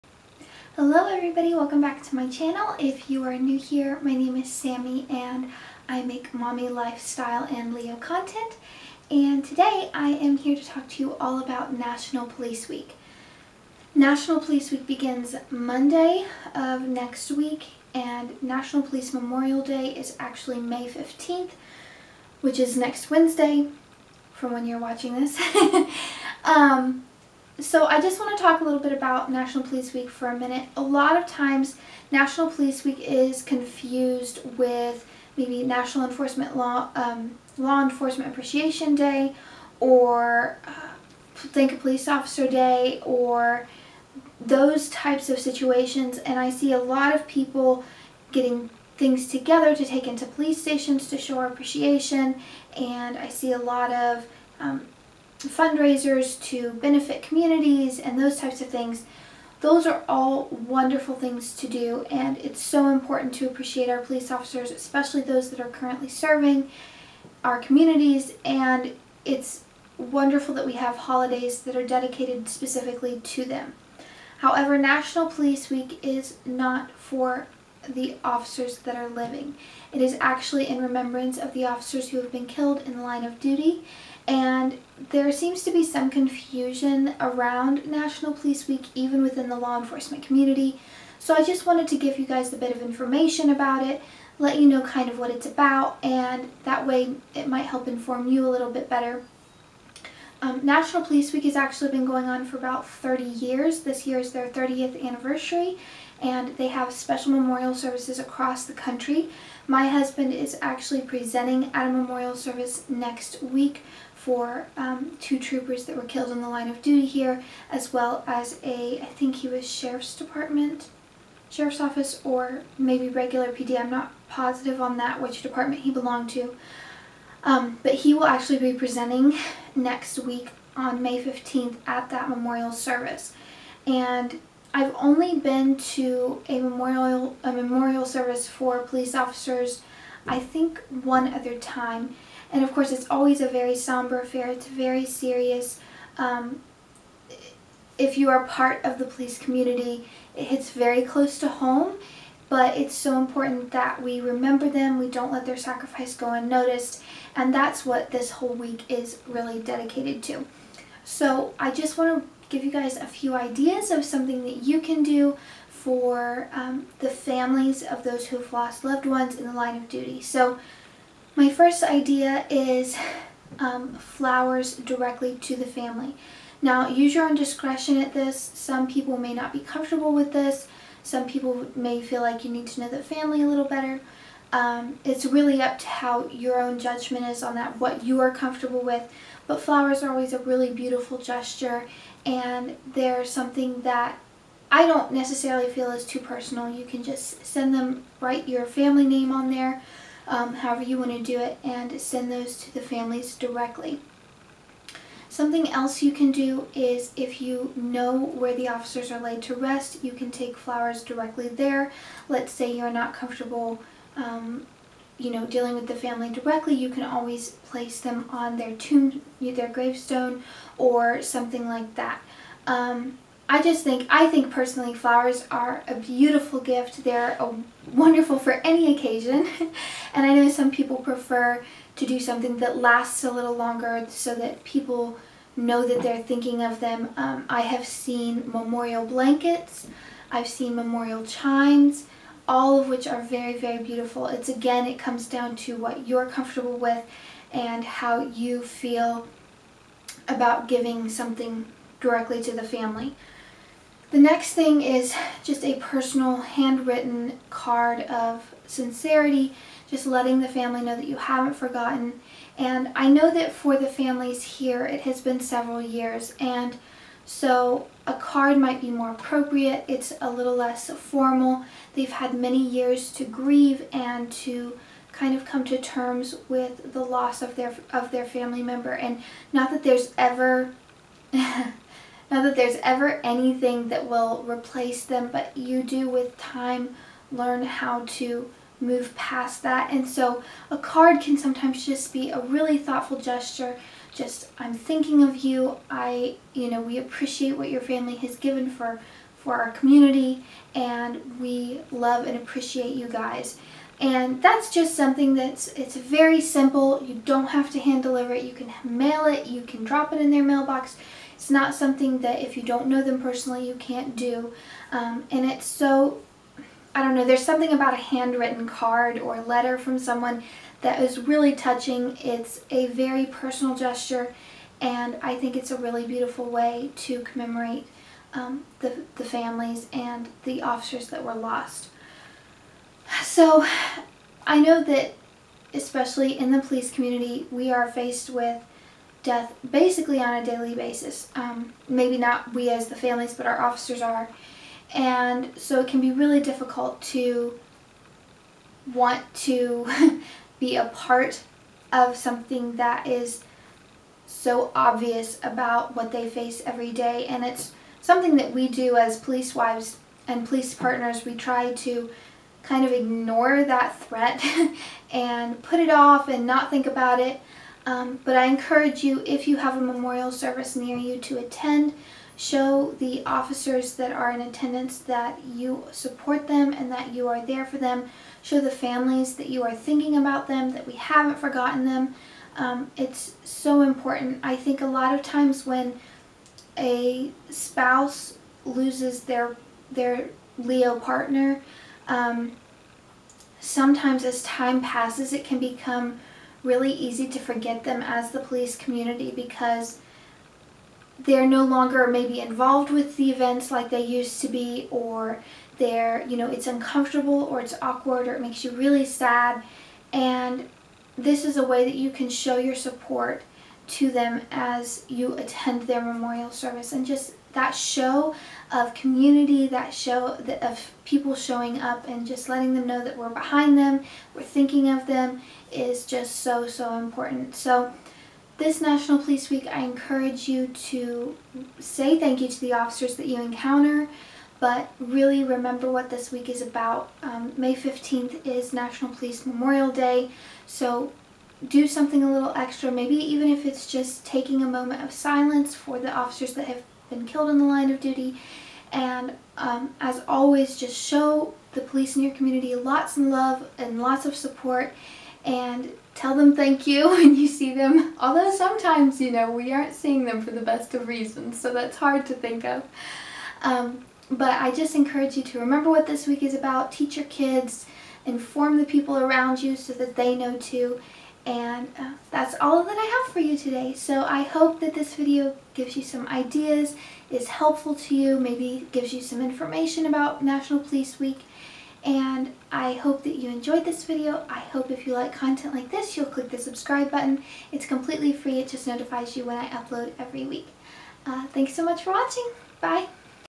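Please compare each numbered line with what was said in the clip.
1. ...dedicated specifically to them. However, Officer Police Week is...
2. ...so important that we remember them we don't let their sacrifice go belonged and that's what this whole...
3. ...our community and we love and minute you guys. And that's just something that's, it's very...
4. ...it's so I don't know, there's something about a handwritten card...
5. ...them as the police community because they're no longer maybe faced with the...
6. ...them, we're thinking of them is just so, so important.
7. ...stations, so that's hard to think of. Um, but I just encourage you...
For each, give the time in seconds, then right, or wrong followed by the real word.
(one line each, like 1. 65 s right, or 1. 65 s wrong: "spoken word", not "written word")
1. 71 s wrong: "National", not "Officer"
2. 152 s wrong: "unnoticed", not "belonged"
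3. 299 s wrong: "appreciate", not "minute"
4. 315 s right
5. 397 s wrong: "involved", not "faced"
6. 423 s right
7. 461 s wrong: "reasons", not "stations".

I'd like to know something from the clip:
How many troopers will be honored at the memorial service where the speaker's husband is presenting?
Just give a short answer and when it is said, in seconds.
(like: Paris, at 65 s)
2, at 115 s.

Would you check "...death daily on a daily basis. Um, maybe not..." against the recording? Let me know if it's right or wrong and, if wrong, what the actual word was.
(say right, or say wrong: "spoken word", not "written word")
wrong: "basically", not "daily".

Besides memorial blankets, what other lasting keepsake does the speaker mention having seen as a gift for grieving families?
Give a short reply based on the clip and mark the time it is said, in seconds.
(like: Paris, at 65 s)
Memorial chimes, at 240 s.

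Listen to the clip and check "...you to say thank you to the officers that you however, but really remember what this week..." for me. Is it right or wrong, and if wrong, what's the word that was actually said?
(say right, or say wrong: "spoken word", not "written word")
wrong: "encounter", not "however".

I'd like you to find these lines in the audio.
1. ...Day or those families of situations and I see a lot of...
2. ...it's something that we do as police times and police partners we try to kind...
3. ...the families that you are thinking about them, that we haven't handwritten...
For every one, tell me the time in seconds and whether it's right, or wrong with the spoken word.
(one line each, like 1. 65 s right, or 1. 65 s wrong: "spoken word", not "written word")
1. 42 s wrong: "types", not "families"
2. 357 s wrong: "wives", not "times"
3. 378 s wrong: "forgotten", not "handwritten".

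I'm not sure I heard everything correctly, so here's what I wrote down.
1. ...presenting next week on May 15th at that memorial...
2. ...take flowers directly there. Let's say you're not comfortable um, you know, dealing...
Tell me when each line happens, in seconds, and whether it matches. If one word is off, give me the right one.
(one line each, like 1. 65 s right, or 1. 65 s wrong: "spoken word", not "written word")
1. 128 s right
2. 210 s right.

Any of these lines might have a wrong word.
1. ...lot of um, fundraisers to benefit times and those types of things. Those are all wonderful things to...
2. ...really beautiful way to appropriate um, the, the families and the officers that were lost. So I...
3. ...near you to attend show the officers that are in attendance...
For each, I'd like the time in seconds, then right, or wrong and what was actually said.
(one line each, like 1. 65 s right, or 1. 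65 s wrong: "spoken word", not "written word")
1. 53 s wrong: "communities", not "times"
2. 325 s wrong: "commemorate", not "appropriate"
3. 370 s right.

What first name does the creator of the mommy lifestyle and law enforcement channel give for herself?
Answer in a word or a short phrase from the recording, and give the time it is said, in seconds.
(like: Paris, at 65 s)
Sammy, at 4 s.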